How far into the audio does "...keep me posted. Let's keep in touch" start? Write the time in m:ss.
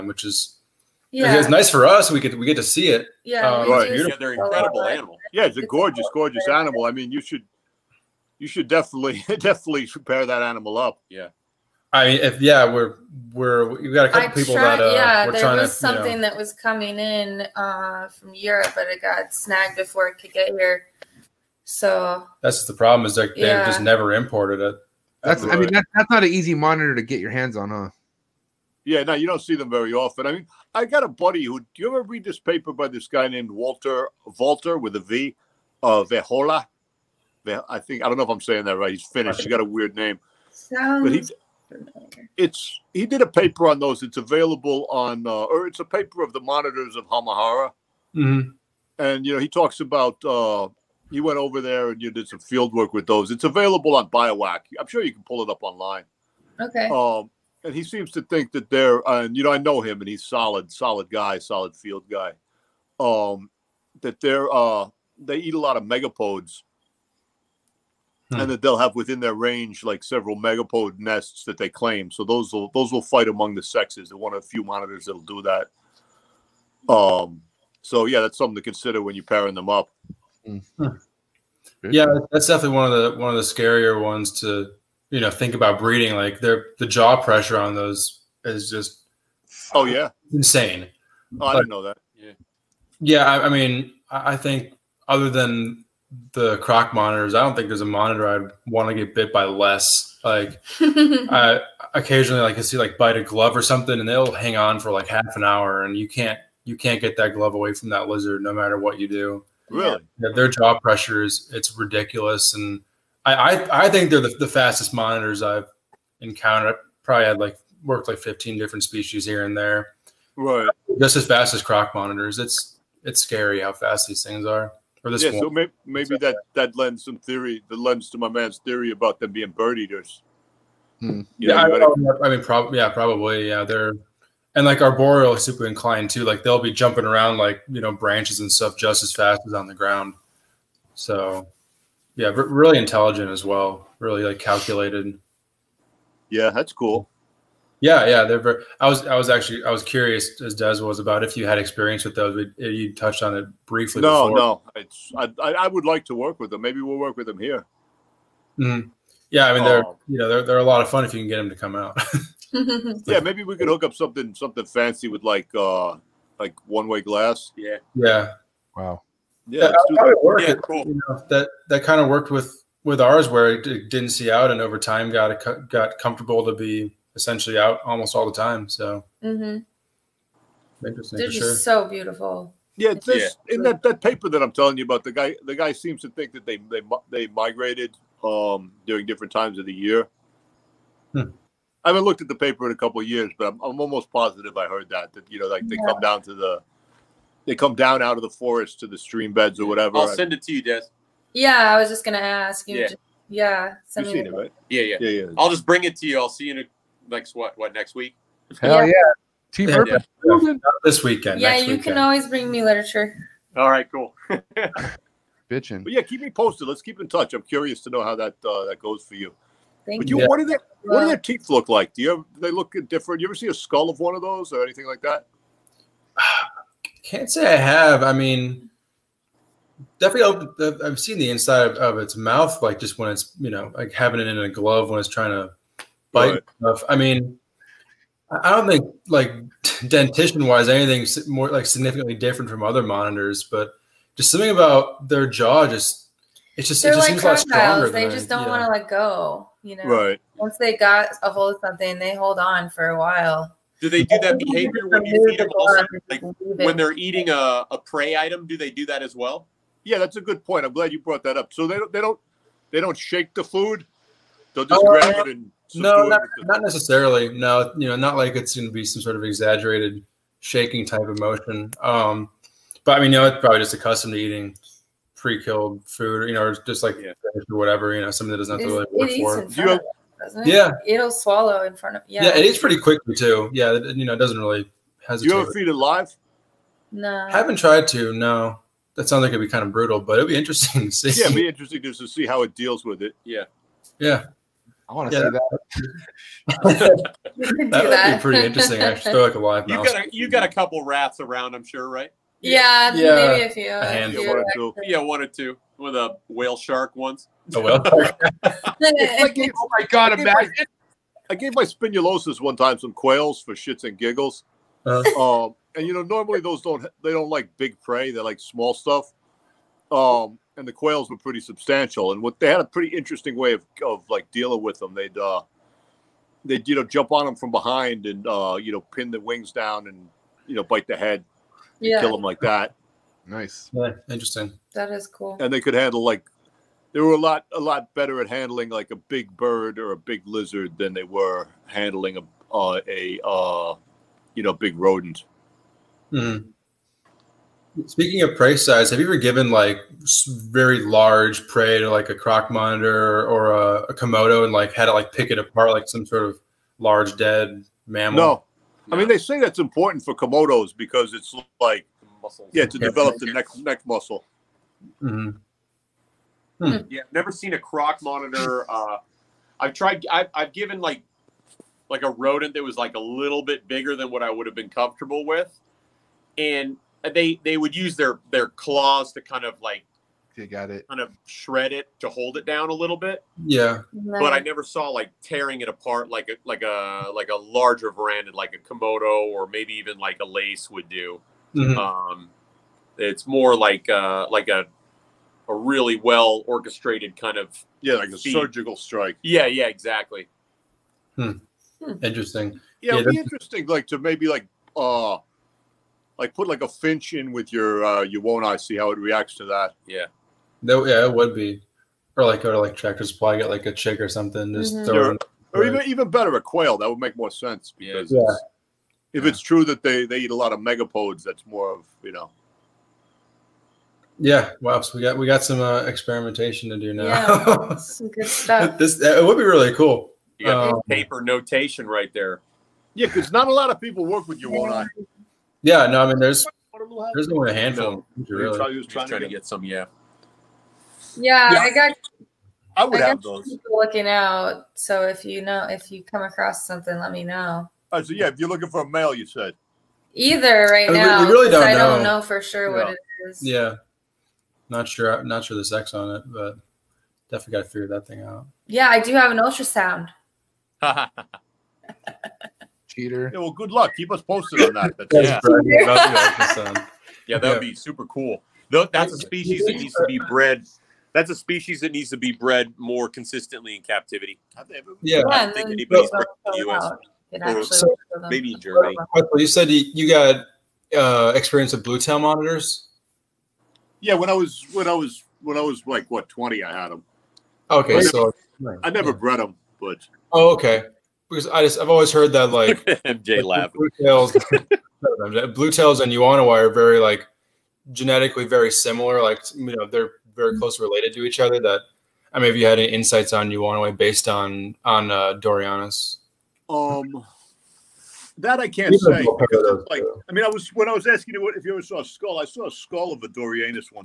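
3:36.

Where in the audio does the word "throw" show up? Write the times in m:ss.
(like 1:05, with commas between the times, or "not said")
4:59, 6:54.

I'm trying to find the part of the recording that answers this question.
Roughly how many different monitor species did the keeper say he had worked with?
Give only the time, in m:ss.
1:58.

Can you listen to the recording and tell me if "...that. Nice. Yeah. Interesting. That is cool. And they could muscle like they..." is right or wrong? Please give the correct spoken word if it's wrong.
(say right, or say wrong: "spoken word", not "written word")
wrong: "handle", not "muscle".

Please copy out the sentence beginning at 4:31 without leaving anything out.
Um, but I mean, you know, it's probably just accustomed to eating pre-killed food, you know, or just like yeah.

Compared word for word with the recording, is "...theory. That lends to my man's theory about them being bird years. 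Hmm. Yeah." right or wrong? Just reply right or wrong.
wrong.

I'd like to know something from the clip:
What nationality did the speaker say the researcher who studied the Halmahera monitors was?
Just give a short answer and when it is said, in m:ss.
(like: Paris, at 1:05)
Finnish, at 0:39.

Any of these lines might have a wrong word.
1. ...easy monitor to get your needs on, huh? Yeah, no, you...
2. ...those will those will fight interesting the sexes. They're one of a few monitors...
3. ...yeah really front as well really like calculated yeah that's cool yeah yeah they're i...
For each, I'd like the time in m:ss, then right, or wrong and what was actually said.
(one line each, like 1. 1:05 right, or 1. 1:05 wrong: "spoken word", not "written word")
1. 0:26 wrong: "hands", not "needs"
2. 1:12 wrong: "among", not "interesting"
3. 2:22 wrong: "intelligent", not "front".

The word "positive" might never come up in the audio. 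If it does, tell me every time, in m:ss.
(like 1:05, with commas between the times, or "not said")
3:14.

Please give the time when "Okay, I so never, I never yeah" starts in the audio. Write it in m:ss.
8:07.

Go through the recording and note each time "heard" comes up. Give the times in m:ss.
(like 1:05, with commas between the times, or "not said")
3:14, 8:12.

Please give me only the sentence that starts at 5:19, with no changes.
Um, and the quails were pretty substantial, and what they had a pretty interesting way of of like dealing with them.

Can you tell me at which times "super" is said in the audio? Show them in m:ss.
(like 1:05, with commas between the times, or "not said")
2:15, 7:47.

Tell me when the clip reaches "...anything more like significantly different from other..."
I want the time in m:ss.
4:00.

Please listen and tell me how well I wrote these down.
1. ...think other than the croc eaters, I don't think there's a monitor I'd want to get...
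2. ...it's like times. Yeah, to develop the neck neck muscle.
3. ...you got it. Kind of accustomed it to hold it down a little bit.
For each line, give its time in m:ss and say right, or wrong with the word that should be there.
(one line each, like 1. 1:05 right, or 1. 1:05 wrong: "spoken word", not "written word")
1. 1:34 wrong: "monitors", not "eaters"
2. 6:01 wrong: "muscles", not "times"
3. 6:20 wrong: "shred", not "accustomed".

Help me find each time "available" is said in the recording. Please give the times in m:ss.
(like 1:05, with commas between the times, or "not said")
0:44, 0:53.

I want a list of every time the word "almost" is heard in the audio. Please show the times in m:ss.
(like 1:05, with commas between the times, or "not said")
2:57, 3:13.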